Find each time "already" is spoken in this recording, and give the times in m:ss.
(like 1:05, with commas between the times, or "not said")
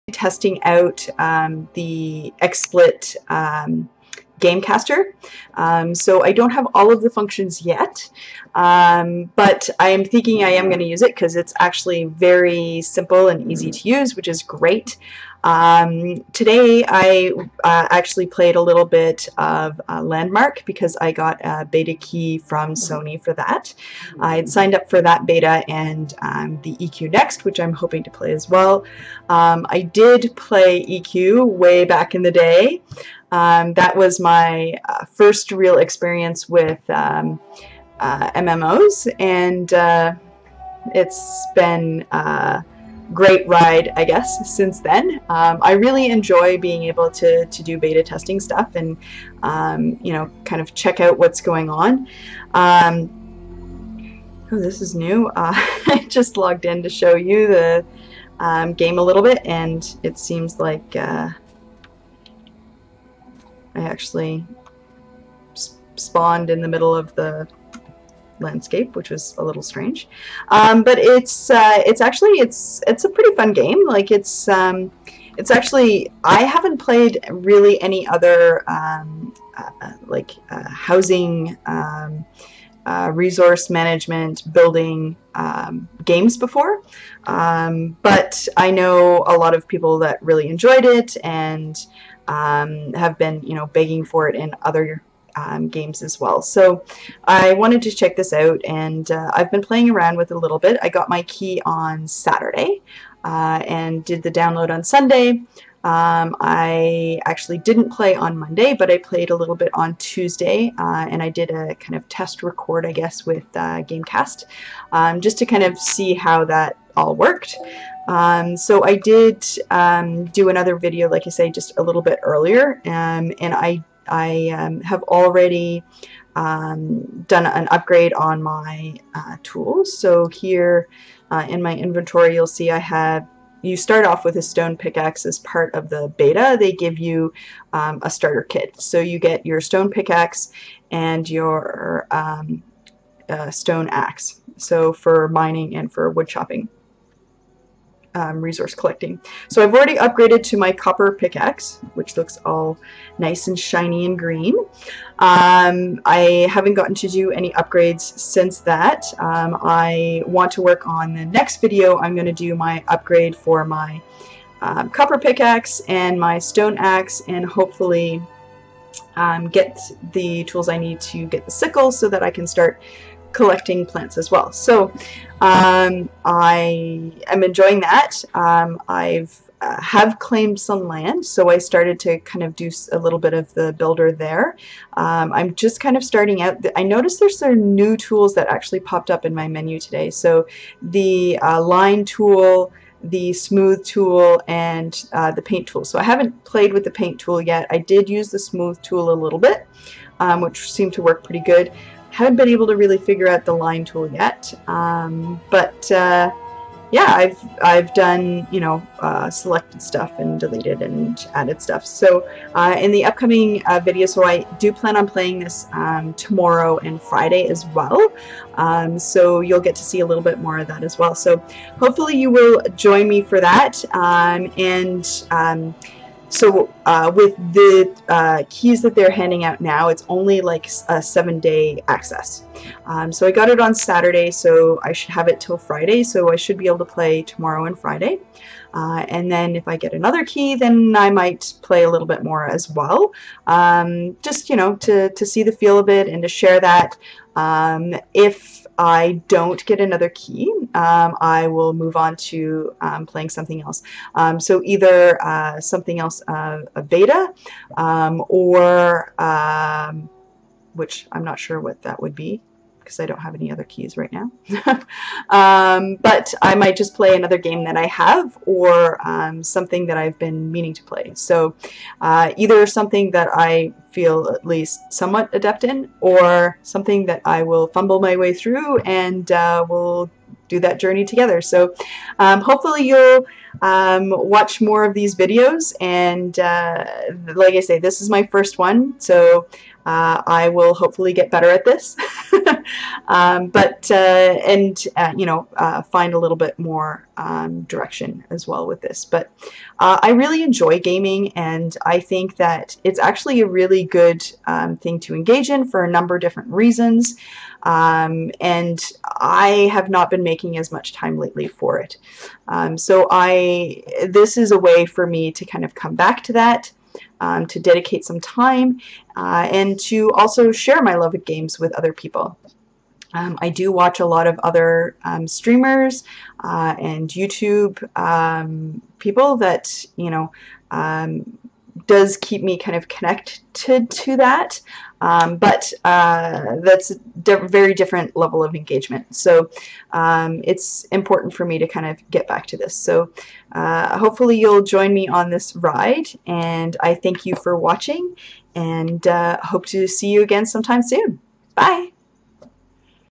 2:05, 2:29.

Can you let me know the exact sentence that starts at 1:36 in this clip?
So I wanted to check this out and uh, I've been playing around with it a little bit.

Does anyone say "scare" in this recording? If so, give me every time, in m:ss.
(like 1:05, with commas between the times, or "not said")
not said.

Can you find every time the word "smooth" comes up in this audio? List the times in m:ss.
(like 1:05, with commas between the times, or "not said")
3:13, 3:18.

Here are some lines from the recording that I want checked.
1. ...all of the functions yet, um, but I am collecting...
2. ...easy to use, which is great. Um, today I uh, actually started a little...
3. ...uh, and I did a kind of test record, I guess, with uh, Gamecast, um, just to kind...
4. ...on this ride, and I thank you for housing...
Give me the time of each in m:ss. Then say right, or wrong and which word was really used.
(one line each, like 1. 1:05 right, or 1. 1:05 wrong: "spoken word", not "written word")
1. 0:06 wrong: "thinking", not "collecting"
2. 0:13 wrong: "played", not "started"
3. 1:50 right
4. 5:45 wrong: "watching", not "housing".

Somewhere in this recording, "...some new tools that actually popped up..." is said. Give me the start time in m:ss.
3:07.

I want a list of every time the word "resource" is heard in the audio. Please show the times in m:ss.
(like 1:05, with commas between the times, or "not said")
1:23, 2:28.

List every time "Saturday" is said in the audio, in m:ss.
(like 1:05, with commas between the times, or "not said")
1:42, 3:53.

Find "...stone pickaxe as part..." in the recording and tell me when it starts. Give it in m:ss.
2:14.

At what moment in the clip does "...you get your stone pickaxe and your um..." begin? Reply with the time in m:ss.
2:18.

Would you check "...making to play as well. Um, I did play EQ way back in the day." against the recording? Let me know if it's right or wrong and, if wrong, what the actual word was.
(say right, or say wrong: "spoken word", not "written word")
wrong: "hoping", not "making".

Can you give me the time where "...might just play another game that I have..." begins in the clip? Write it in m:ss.
4:26.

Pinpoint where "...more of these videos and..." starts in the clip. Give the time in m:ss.
4:44.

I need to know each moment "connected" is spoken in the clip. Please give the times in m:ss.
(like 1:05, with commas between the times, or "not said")
5:32.